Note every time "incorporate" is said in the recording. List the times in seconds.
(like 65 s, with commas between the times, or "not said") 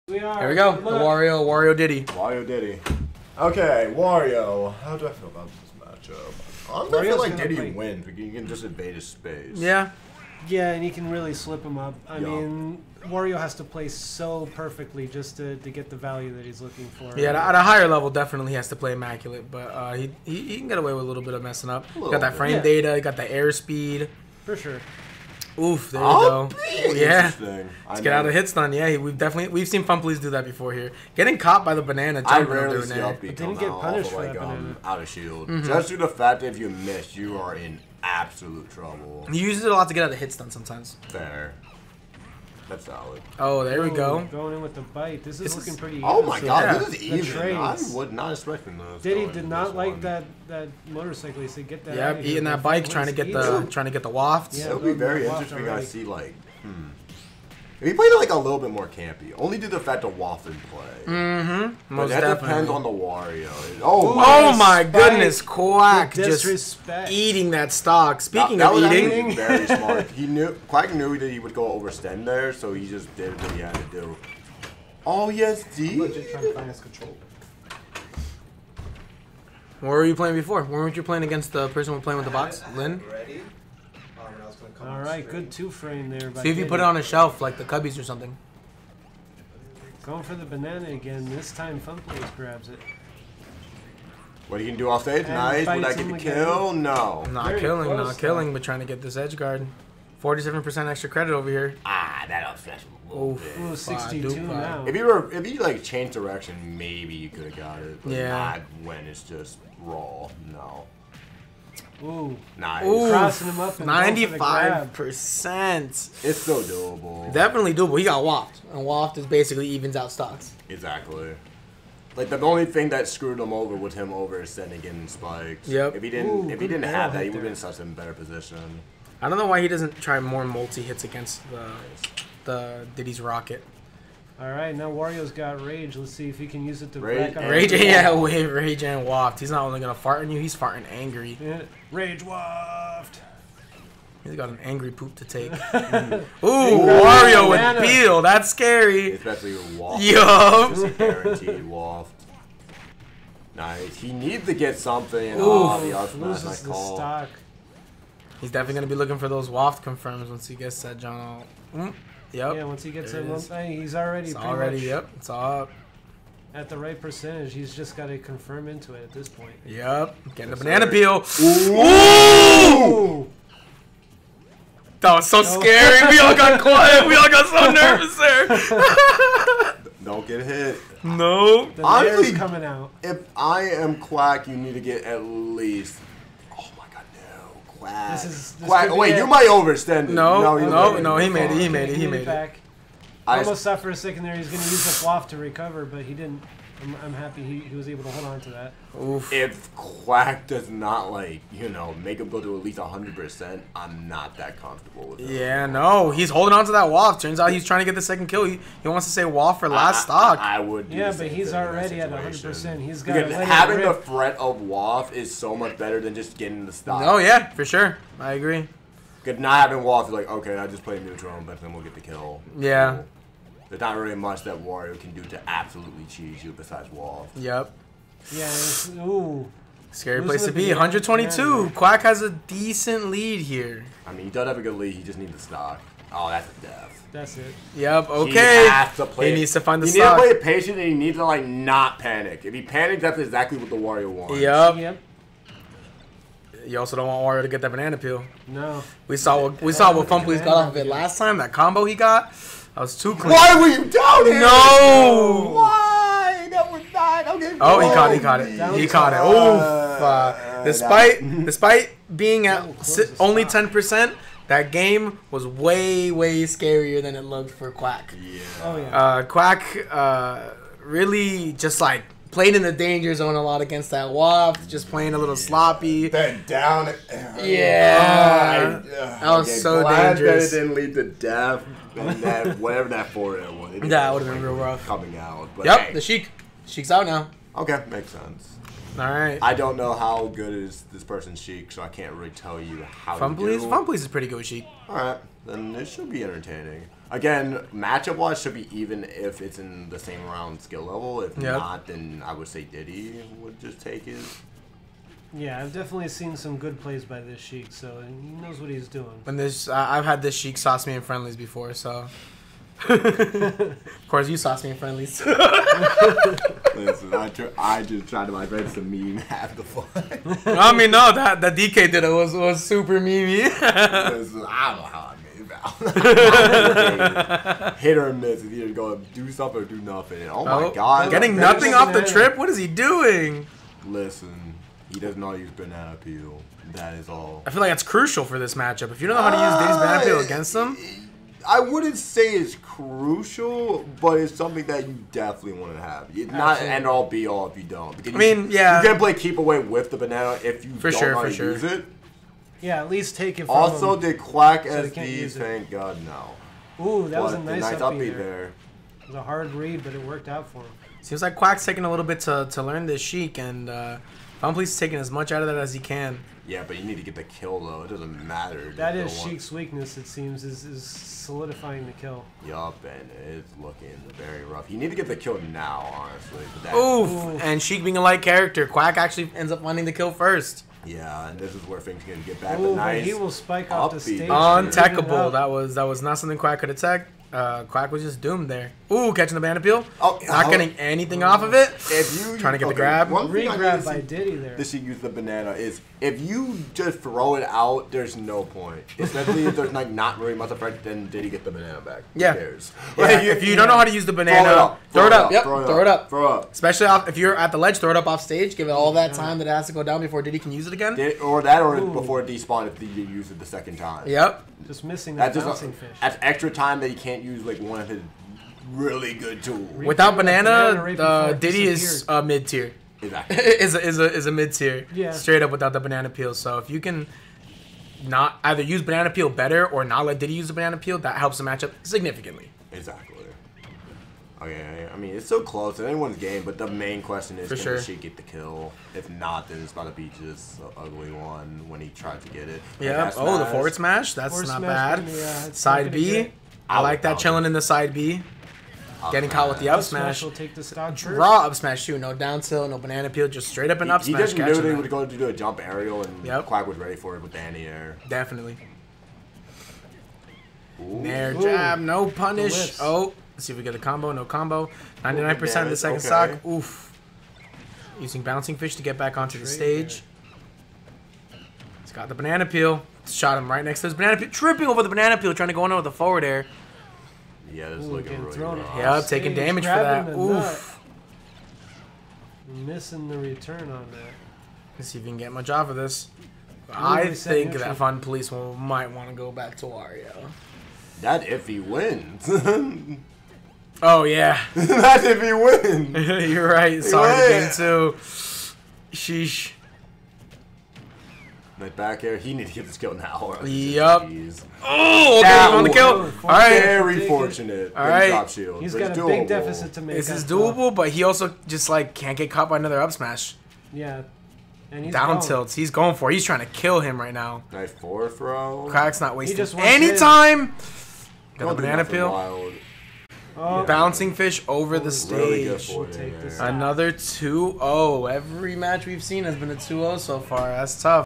not said.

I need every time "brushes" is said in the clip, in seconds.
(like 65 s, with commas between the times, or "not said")
not said.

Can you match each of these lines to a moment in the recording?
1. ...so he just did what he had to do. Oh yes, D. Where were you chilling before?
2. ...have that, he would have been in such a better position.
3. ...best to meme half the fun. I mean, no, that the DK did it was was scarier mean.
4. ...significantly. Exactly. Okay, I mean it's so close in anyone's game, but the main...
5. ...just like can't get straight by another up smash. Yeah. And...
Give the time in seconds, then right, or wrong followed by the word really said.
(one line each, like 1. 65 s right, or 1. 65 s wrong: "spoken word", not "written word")
1. 72 s wrong: "playing", not "chilling"
2. 126 s right
3. 318 s wrong: "super", not "scarier"
4. 431 s right
5. 511 s wrong: "caught", not "straight".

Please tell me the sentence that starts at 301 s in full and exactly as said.
not, then I would say Diddy would just take his.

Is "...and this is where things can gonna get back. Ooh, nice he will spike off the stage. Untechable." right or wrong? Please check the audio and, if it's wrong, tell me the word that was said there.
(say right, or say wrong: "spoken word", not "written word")
right.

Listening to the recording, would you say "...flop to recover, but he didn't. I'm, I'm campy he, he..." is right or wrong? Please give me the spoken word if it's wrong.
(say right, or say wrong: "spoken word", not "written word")
wrong: "happy", not "campy".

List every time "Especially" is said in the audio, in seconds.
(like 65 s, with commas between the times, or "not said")
149 s, 398 s, 406 s.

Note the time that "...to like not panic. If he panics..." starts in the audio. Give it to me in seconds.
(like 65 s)
241 s.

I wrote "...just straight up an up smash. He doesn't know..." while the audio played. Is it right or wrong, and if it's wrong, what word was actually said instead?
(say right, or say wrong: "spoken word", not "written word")
right.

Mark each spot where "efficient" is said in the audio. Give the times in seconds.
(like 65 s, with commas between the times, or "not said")
not said.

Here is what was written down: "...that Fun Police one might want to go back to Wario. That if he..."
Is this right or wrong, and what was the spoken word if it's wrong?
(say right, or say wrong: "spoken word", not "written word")
right.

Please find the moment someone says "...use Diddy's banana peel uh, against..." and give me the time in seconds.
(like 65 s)
339 s.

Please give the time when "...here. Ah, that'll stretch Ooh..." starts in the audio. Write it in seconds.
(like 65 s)
101 s.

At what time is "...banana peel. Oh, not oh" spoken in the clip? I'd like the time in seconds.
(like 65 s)
389 s.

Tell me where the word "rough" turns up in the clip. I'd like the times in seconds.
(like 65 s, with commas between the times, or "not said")
284 s, 374 s, 478 s.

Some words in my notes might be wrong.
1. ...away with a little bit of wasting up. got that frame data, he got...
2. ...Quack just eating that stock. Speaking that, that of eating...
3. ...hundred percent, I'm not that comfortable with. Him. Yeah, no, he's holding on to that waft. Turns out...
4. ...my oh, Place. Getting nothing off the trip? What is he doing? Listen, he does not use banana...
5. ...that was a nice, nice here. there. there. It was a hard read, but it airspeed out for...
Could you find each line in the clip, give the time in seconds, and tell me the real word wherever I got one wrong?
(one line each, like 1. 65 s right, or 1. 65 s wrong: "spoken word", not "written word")
1. 20 s wrong: "messing", not "wasting"
2. 65 s right
3. 202 s right
4. 330 s wrong: "God", not "Place"
5. 357 s wrong: "worked", not "airspeed".